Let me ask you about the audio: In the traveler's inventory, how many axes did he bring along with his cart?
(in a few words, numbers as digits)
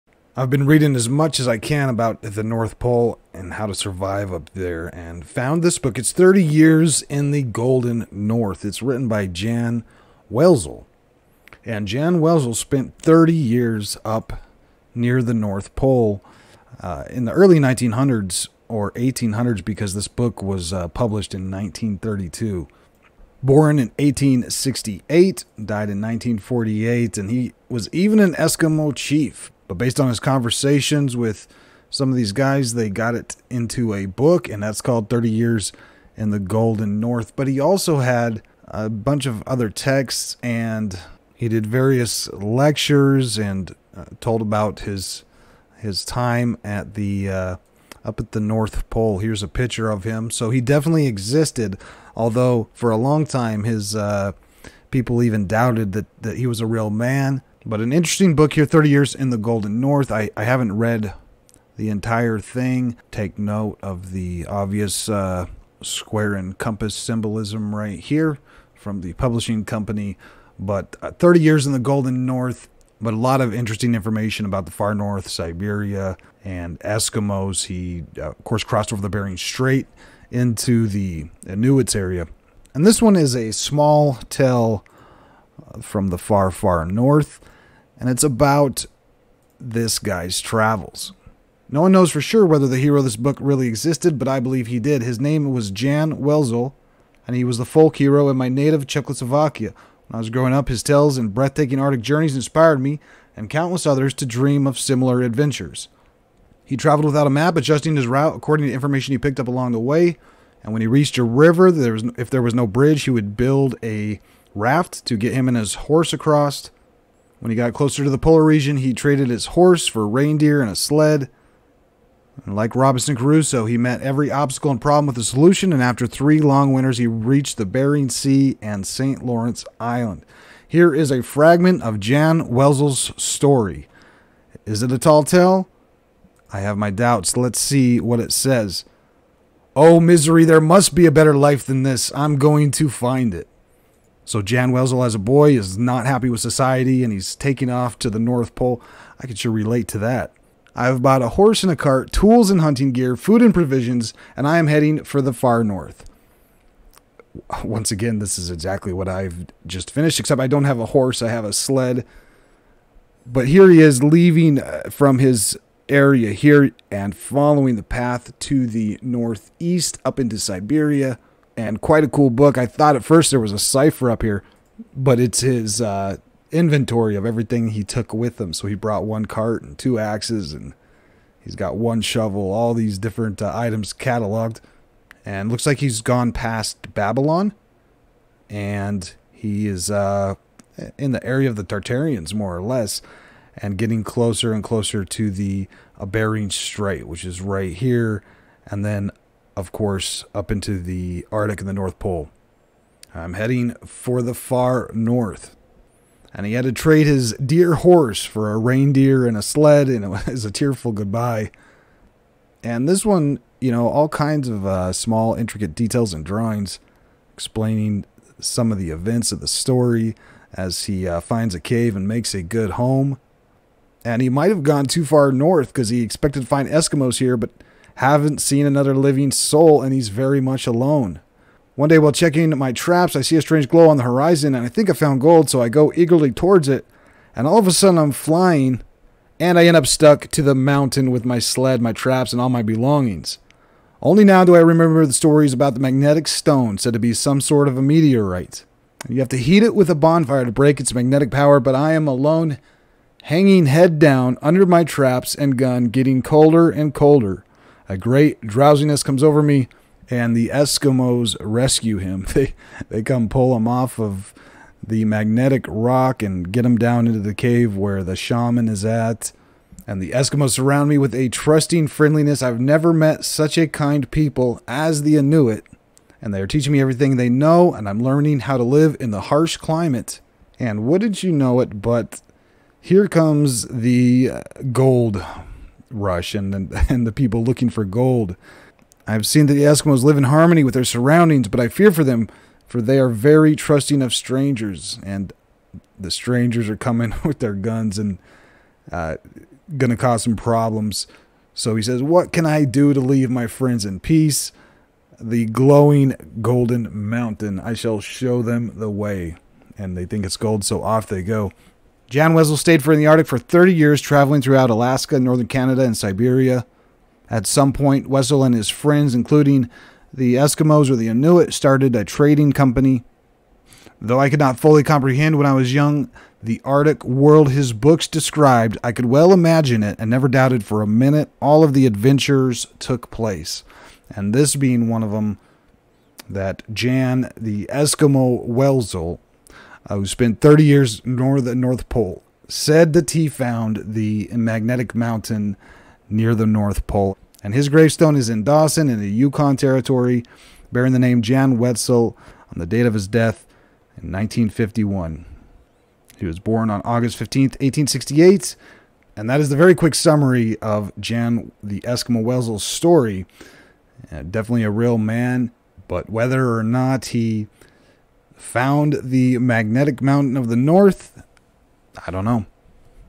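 2.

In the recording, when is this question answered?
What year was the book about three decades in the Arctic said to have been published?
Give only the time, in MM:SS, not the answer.
00:21.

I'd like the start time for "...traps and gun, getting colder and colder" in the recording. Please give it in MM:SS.
04:14.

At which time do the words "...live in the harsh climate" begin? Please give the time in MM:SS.
04:38.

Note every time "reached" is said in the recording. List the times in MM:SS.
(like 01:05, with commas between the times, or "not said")
01:50, 02:07.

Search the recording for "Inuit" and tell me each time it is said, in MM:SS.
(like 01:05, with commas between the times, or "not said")
01:21, 04:35, 05:21.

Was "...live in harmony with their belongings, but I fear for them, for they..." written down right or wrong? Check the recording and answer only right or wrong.
wrong.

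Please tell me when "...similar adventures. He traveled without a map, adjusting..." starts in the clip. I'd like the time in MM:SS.
01:44.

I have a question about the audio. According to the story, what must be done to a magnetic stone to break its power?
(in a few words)
heat it with a bonfire.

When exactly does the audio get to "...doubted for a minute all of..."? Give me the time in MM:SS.
05:30.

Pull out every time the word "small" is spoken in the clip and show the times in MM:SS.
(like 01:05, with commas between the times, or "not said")
01:23, 03:34.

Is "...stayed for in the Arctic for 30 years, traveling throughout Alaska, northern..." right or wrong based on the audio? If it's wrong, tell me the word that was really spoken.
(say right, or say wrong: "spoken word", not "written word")
right.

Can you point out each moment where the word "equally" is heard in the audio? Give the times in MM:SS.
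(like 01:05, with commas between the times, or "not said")
not said.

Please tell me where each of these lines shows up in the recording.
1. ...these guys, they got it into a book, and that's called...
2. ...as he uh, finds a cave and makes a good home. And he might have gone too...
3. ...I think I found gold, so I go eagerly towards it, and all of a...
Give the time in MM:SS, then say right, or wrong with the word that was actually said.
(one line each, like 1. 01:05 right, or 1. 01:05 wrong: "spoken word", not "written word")
1. 00:32 right
2. 03:40 right
3. 03:54 right.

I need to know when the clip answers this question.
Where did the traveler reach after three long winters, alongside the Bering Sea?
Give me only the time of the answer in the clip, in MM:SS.
02:08.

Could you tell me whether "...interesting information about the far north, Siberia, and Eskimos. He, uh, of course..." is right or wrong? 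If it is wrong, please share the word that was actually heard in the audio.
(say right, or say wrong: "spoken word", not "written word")
right.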